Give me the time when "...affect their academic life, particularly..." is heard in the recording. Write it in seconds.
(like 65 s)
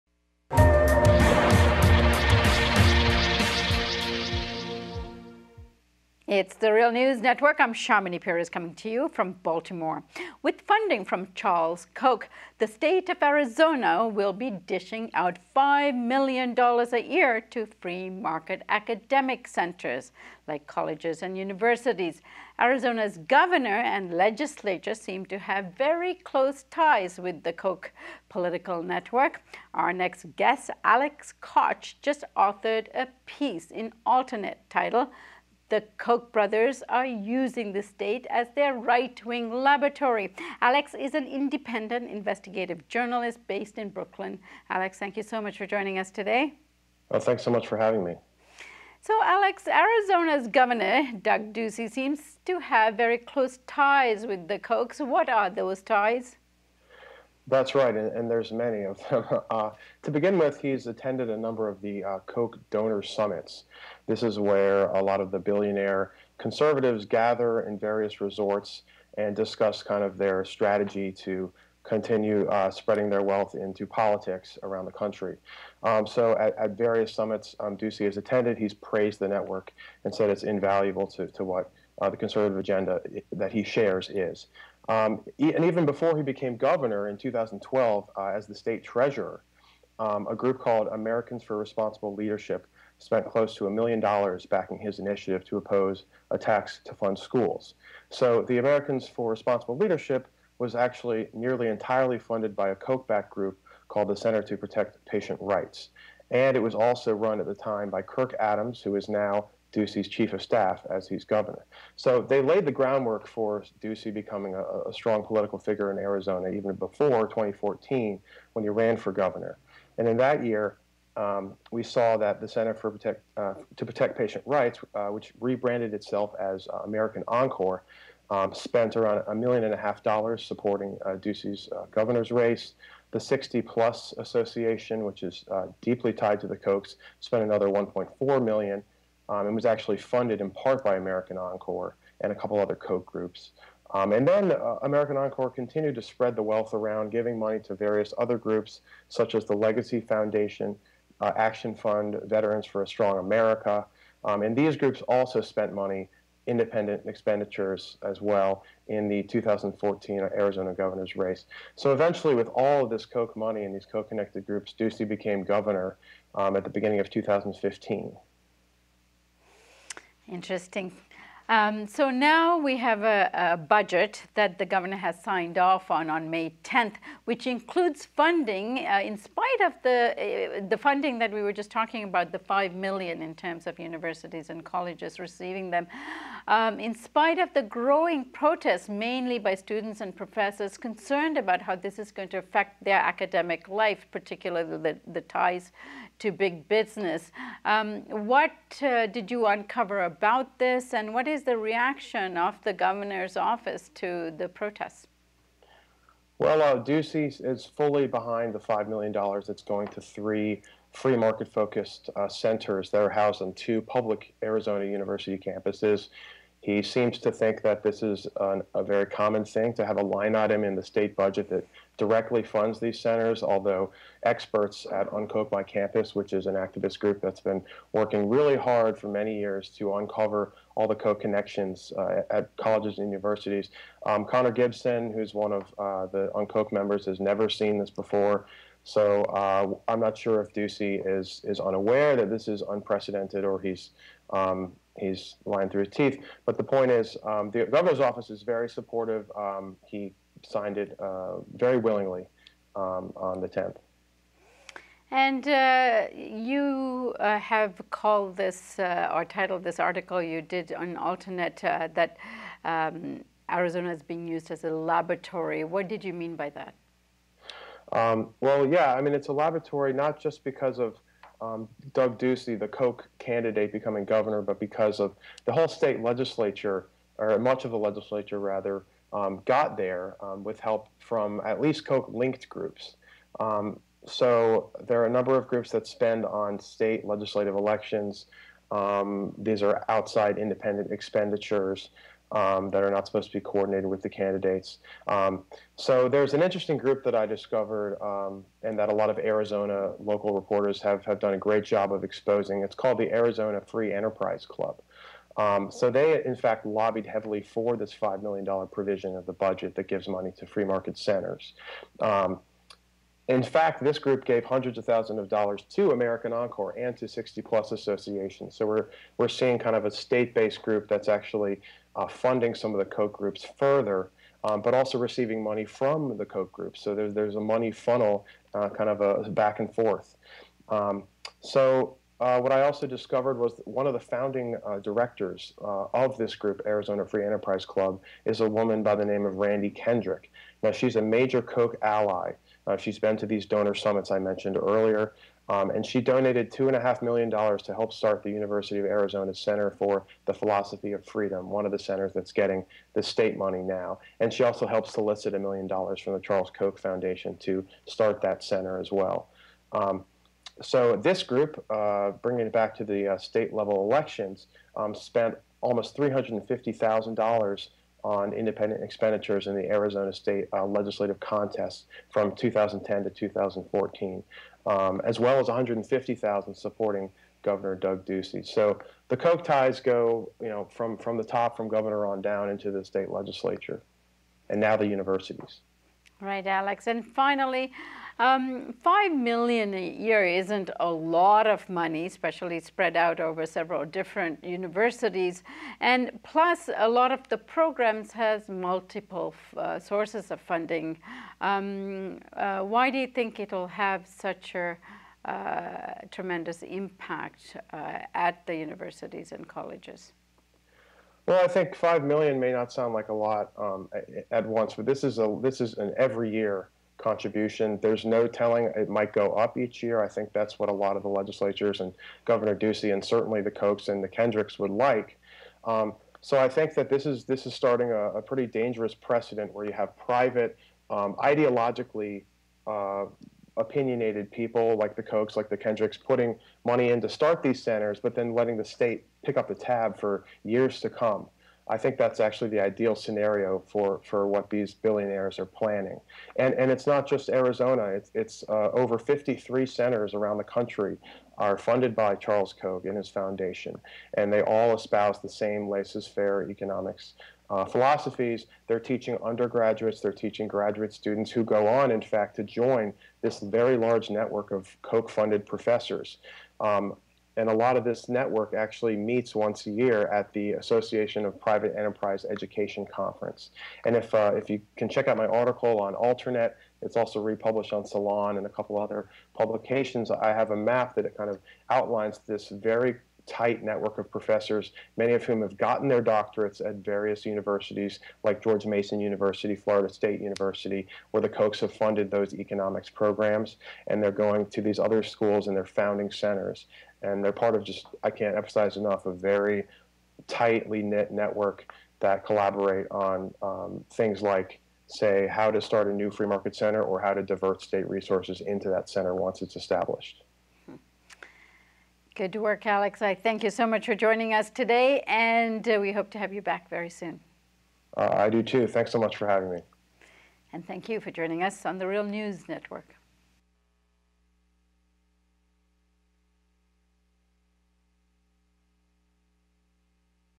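192 s.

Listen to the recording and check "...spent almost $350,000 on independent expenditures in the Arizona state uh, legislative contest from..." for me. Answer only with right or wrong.
right.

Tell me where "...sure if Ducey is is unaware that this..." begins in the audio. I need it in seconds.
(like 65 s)
240 s.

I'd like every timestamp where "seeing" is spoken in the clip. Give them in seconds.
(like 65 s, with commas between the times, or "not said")
319 s.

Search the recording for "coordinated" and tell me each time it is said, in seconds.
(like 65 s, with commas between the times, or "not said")
293 s.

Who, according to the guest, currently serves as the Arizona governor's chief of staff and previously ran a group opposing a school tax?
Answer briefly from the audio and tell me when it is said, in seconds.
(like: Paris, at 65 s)
Kirk Adams, at 108 s.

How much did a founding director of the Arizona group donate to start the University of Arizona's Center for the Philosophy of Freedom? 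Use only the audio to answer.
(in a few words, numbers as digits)
$2.5 million.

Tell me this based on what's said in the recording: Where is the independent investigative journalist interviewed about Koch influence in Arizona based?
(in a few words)
Brooklyn.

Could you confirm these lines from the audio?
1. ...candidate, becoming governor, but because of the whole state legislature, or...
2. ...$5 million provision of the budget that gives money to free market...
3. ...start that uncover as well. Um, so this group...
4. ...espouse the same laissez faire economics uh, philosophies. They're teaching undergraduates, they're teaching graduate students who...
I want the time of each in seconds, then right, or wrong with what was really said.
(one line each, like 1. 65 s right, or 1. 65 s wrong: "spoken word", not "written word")
1. 273 s right
2. 307 s right
3. 357 s wrong: "center", not "uncover"
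4. 454 s right.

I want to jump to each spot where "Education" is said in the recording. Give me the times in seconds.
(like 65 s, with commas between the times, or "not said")
472 s.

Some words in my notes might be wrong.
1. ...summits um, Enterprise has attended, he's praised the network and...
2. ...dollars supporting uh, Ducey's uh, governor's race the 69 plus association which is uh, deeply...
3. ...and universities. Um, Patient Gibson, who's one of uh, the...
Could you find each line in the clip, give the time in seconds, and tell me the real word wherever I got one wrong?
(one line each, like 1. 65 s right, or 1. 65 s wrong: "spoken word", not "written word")
1. 77 s wrong: "Ducey", not "Enterprise"
2. 130 s wrong: "60", not "69"
3. 232 s wrong: "Connor", not "Patient".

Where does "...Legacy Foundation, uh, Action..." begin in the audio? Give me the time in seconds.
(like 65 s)
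149 s.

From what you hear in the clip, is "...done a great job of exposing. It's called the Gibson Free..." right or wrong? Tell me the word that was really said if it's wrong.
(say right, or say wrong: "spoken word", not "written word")
wrong: "Arizona", not "Gibson".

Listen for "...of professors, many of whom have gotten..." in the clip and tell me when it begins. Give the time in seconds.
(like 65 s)
483 s.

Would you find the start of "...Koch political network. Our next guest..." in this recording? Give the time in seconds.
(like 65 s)
27 s.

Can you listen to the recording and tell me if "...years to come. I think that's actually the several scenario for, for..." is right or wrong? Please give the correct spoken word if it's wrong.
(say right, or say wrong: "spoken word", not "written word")
wrong: "ideal", not "several".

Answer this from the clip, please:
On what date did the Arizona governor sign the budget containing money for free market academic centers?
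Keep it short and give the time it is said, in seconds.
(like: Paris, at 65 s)
May 10th, at 176 s.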